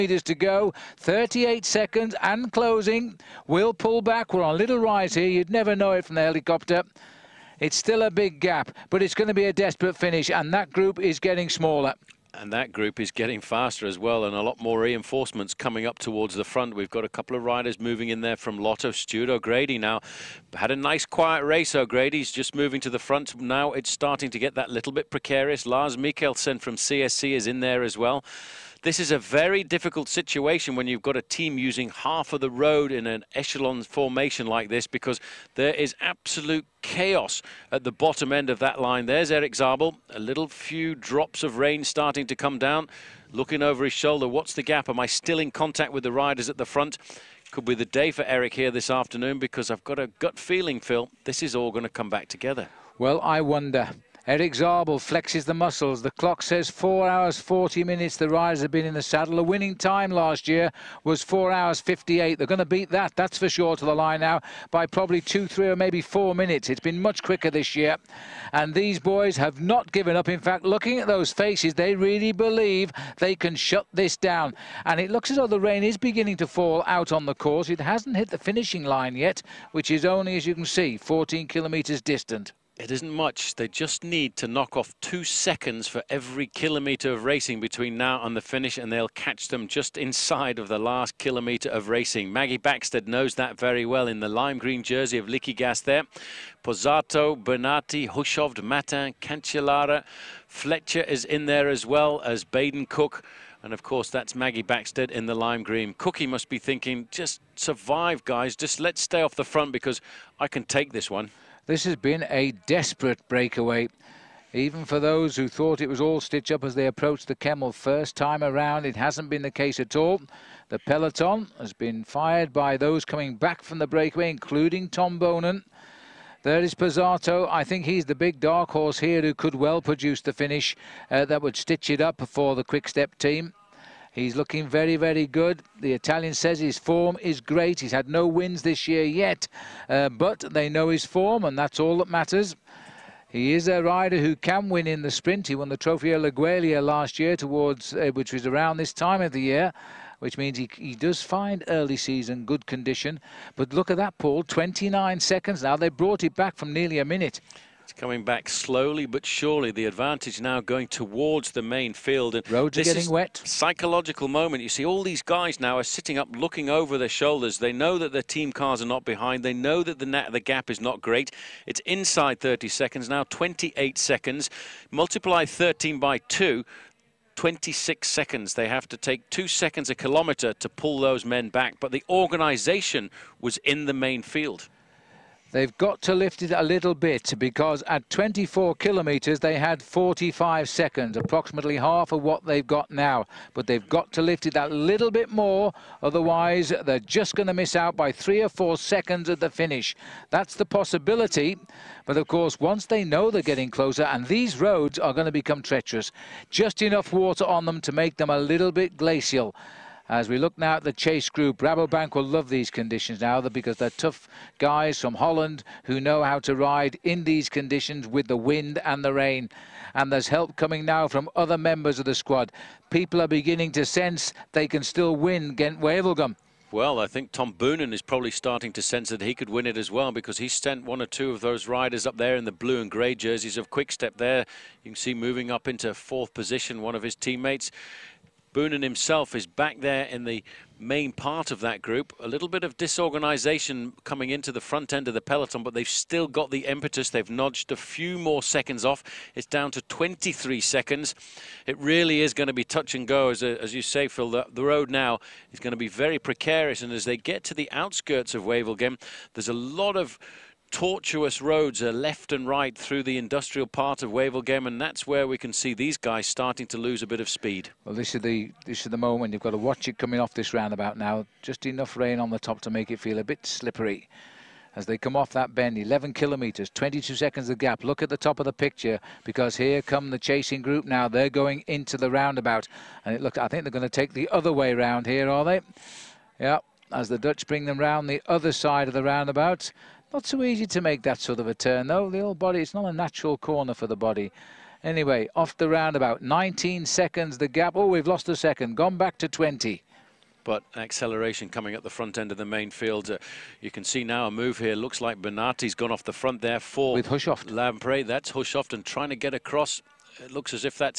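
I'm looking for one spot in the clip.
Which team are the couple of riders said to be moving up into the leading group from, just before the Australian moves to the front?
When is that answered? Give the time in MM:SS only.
00:18.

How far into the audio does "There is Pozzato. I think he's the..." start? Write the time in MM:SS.
02:06.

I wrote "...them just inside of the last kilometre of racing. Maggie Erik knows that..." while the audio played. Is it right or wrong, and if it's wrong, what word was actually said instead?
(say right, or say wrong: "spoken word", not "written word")
wrong: "Backstedt", not "Erik".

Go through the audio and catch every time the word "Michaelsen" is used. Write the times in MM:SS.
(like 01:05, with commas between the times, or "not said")
00:25.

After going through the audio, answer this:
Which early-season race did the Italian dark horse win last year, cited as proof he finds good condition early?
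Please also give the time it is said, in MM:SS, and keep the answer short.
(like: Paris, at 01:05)
Trofeo Laigueglia, at 02:25.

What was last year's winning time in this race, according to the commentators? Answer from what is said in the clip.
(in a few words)
4 hours 58.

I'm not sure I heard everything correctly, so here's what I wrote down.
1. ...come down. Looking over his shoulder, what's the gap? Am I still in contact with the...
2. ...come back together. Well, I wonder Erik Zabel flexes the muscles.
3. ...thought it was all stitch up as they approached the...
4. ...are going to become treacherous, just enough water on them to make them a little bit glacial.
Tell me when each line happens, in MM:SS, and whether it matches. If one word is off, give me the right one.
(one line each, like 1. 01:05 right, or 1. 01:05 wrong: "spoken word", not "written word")
1. 00:42 right
2. 00:51 right
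3. 01:55 right
4. 03:24 right.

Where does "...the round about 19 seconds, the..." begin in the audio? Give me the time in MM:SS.
04:55.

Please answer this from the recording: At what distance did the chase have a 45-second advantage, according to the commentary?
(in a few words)
24 kilometres.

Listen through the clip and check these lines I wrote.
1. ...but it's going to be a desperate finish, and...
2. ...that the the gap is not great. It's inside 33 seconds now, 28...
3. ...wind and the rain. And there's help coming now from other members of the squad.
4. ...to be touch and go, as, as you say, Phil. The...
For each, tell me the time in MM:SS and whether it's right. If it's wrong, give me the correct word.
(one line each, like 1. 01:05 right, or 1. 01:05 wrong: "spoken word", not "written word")
1. 00:08 right
2. 02:49 wrong: "30", not "33"
3. 03:38 right
4. 04:12 right.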